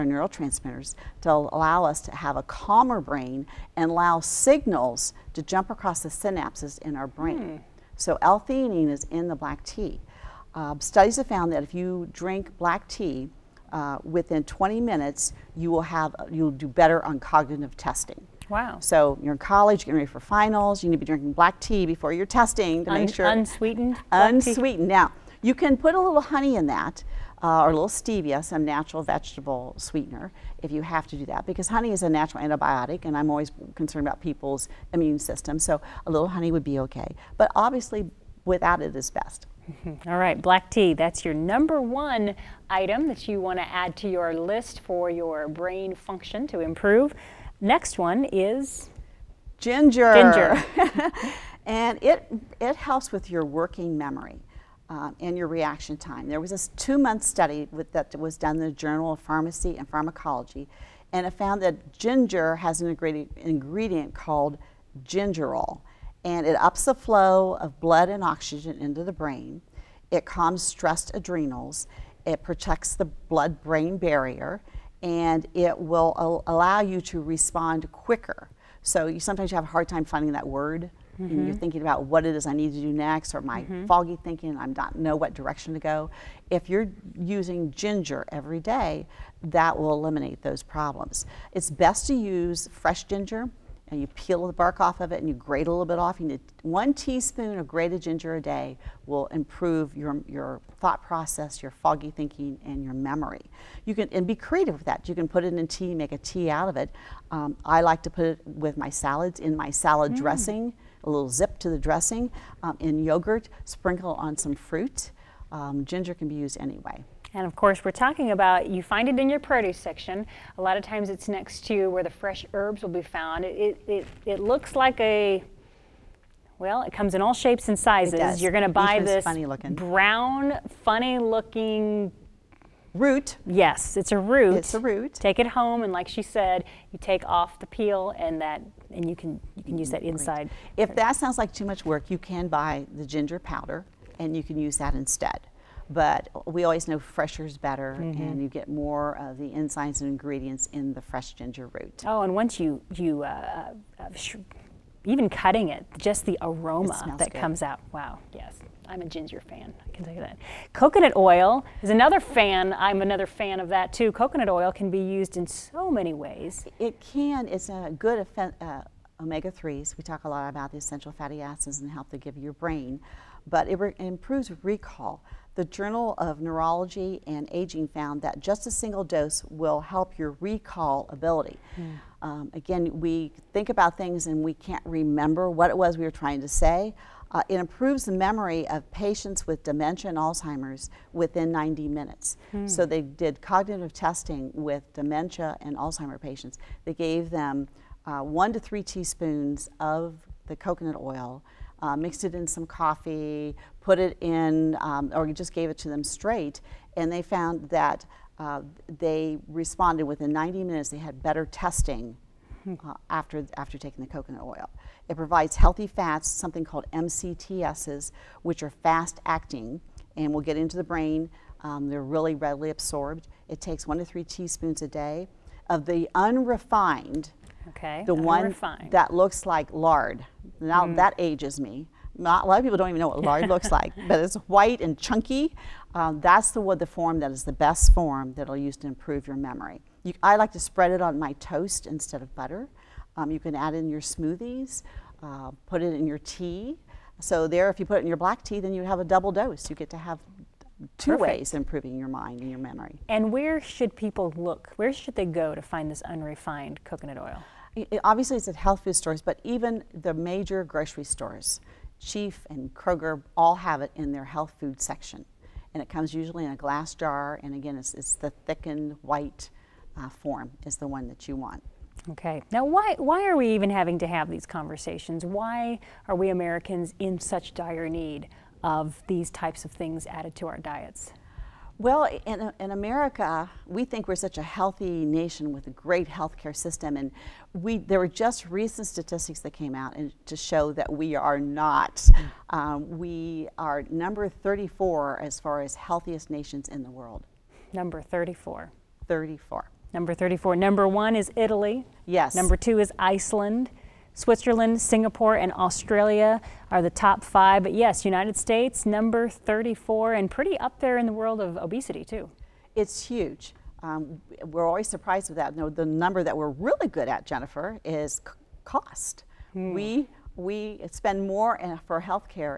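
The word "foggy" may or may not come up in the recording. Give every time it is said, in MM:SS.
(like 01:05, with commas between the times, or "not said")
01:23, 01:41.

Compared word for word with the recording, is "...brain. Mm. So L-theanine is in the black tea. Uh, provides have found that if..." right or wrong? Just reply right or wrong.
wrong.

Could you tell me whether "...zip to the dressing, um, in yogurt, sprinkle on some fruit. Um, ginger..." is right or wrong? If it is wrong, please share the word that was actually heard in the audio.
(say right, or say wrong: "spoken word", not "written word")
right.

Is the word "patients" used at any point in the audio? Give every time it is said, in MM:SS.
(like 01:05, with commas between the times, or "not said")
03:08, 03:16.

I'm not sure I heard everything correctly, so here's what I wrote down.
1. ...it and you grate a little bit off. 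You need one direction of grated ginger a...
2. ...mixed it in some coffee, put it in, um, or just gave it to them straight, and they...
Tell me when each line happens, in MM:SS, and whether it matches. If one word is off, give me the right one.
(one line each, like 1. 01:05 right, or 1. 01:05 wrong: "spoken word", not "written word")
1. 01:35 wrong: "teaspoon", not "direction"
2. 03:21 right.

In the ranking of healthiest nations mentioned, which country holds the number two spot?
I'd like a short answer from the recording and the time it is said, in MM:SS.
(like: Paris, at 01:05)
Iceland, at 05:02.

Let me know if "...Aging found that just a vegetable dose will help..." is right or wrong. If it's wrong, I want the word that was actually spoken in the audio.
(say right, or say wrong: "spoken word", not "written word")
wrong: "single", not "vegetable".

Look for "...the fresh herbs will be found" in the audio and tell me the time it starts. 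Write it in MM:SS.
02:02.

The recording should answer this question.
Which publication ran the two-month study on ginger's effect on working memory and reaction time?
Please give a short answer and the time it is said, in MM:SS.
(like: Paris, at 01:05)
Journal of Pharmacy and Pharmacology, at 00:58.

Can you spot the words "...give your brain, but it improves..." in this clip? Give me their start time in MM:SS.
02:52.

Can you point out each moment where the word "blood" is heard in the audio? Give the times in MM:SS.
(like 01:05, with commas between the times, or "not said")
01:07, 01:13.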